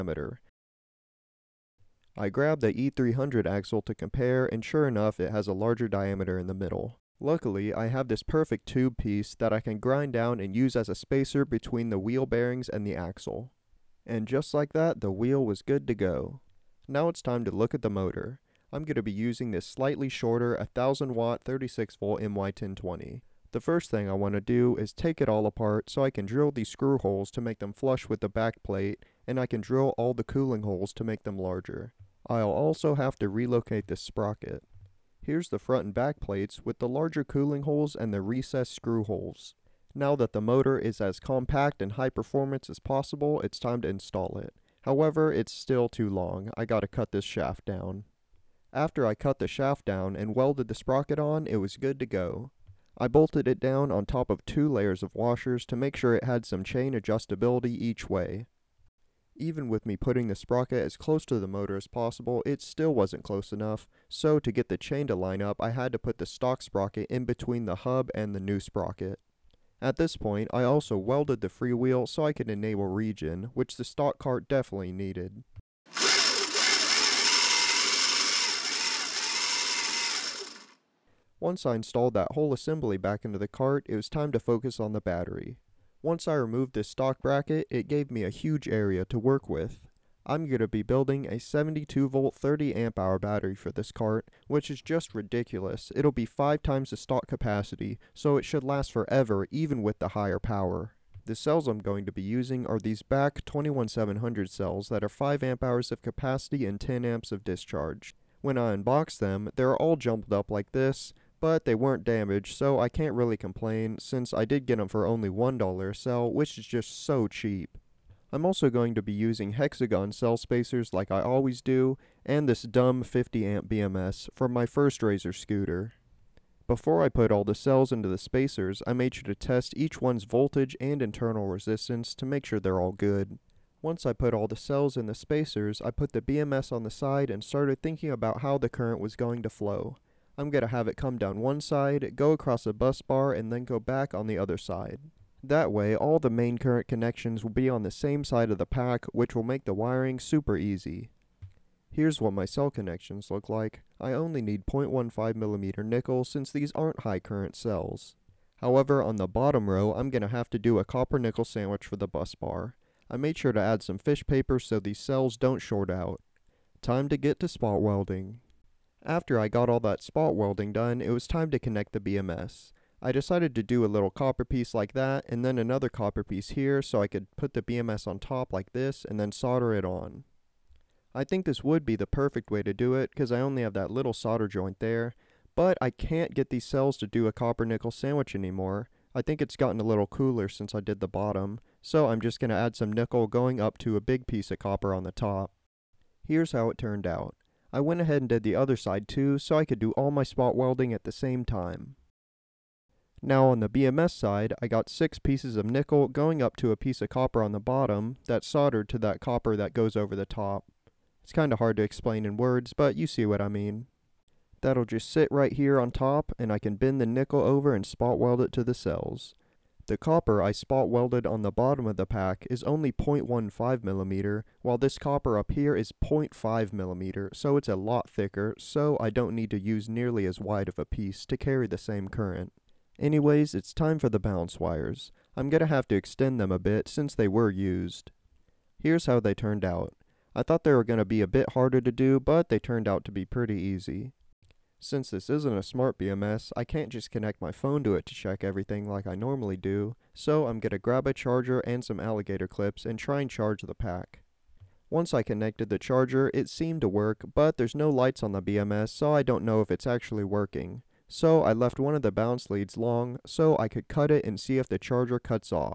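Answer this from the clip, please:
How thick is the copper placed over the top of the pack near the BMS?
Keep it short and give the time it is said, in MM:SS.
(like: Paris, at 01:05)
0.5mm, at 03:46.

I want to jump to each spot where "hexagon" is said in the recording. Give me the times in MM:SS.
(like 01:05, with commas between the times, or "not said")
01:59.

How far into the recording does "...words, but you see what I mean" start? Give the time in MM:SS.
03:32.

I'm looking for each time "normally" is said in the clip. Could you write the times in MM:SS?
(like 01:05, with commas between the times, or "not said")
04:09.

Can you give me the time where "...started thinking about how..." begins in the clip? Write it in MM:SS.
02:17.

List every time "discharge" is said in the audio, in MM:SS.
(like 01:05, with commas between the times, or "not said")
01:47.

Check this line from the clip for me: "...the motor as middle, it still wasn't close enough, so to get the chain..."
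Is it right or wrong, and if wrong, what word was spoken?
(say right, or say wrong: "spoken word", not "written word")
wrong: "possible", not "middle".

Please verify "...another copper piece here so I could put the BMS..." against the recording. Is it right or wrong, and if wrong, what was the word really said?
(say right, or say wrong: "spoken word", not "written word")
right.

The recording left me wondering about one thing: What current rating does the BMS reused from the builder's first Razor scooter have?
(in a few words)
50 amp.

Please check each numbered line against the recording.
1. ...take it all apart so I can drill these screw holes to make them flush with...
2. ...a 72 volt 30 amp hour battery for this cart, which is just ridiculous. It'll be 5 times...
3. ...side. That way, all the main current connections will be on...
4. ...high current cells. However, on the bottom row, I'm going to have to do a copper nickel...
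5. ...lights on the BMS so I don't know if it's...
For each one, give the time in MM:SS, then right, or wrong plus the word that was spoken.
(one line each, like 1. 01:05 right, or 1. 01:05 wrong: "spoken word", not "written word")
1. 00:24 right
2. 01:31 right
3. 02:24 right
4. 02:37 right
5. 04:17 right.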